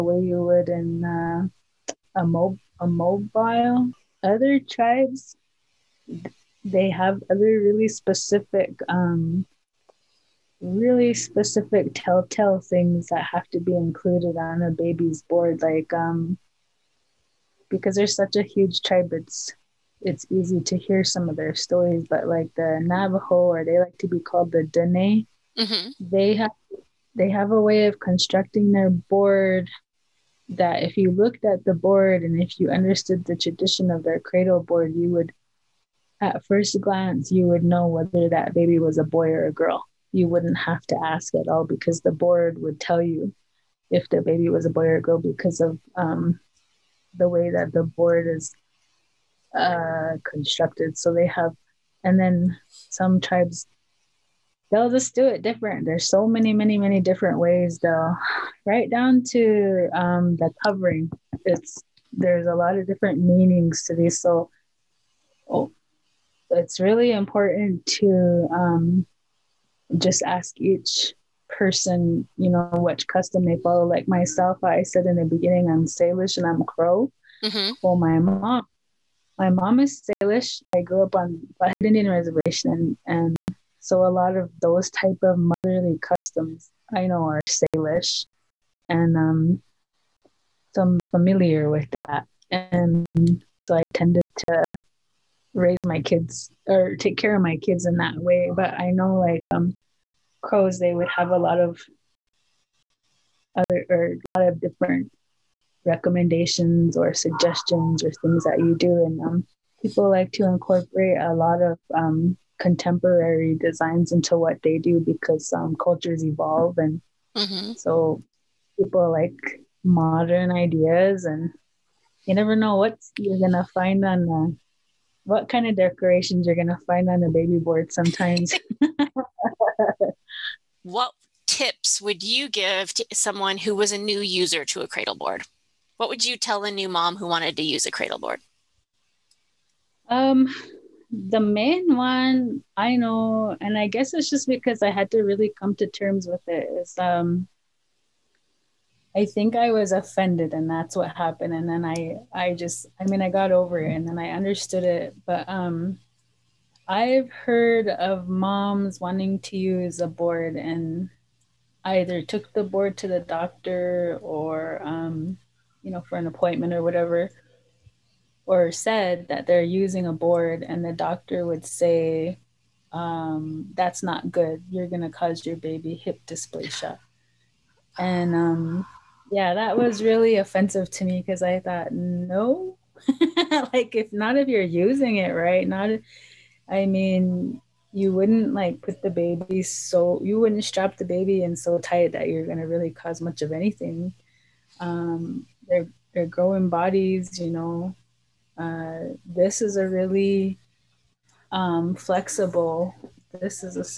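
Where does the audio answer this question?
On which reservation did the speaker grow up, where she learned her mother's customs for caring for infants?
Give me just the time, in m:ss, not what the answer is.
1:21.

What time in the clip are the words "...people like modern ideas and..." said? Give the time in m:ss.
1:58.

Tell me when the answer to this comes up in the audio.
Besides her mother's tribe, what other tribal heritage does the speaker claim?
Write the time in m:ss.
1:16.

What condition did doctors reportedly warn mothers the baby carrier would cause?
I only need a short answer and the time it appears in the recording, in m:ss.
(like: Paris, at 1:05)
hip dysplasia, at 2:55.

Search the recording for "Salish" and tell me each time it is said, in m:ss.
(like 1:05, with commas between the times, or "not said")
1:15, 1:20, 1:27.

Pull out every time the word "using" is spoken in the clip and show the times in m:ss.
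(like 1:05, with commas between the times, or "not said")
2:49, 3:04.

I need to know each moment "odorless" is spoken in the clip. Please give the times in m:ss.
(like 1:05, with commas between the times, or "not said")
not said.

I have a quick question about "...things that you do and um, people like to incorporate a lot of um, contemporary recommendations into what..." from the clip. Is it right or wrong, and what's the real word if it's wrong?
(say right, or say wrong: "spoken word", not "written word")
wrong: "designs", not "recommendations".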